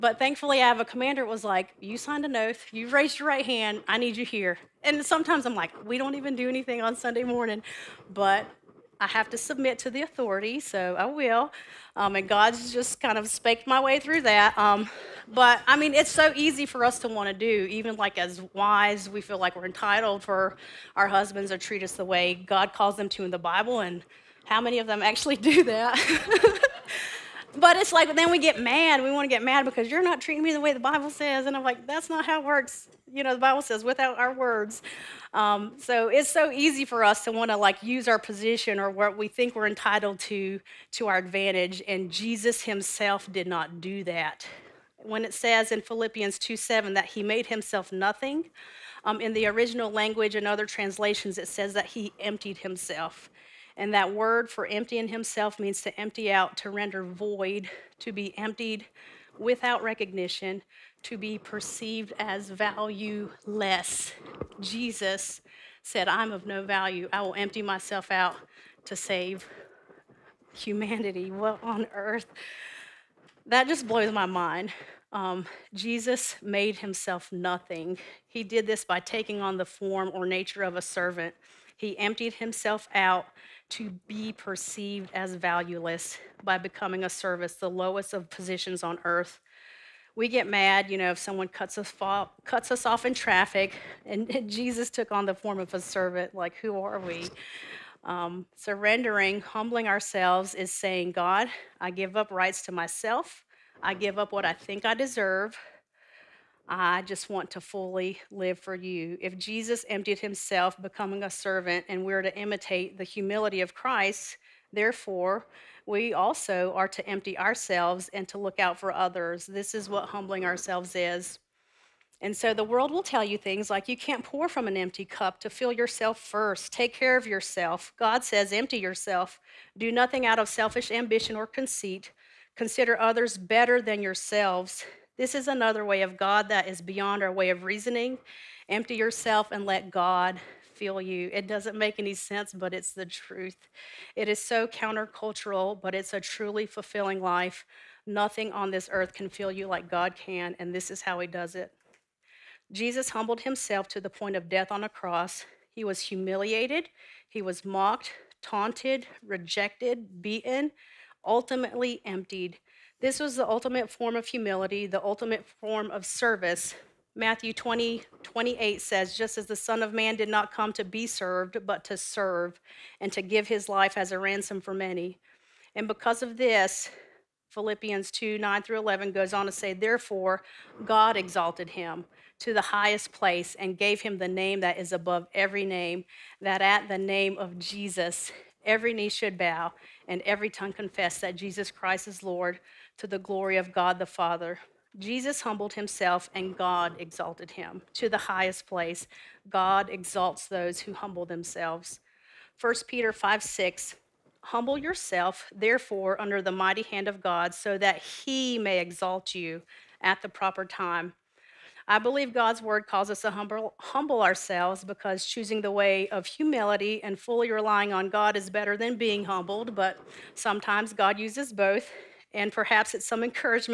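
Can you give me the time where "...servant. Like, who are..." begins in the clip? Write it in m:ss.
1:35.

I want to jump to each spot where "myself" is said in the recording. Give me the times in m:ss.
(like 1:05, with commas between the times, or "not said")
1:07, 1:42.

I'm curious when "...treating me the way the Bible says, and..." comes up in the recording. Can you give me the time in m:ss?
0:30.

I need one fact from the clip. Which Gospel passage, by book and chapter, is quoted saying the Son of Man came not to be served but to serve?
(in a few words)
Matthew 20:28.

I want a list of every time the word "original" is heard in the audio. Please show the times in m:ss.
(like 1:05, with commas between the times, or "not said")
0:49.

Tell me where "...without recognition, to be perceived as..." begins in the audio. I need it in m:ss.
0:59.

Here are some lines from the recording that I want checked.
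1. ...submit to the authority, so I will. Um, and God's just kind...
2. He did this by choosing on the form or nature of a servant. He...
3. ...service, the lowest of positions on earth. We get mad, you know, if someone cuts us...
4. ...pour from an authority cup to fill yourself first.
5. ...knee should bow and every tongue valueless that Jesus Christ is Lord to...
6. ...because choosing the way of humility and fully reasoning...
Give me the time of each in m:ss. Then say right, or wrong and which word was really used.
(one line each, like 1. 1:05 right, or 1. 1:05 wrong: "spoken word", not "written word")
1. 0:09 right
2. 1:18 wrong: "taking", not "choosing"
3. 1:27 right
4. 2:04 wrong: "empty", not "authority"
5. 3:08 wrong: "confess", not "valueless"
6. 3:34 wrong: "relying", not "reasoning".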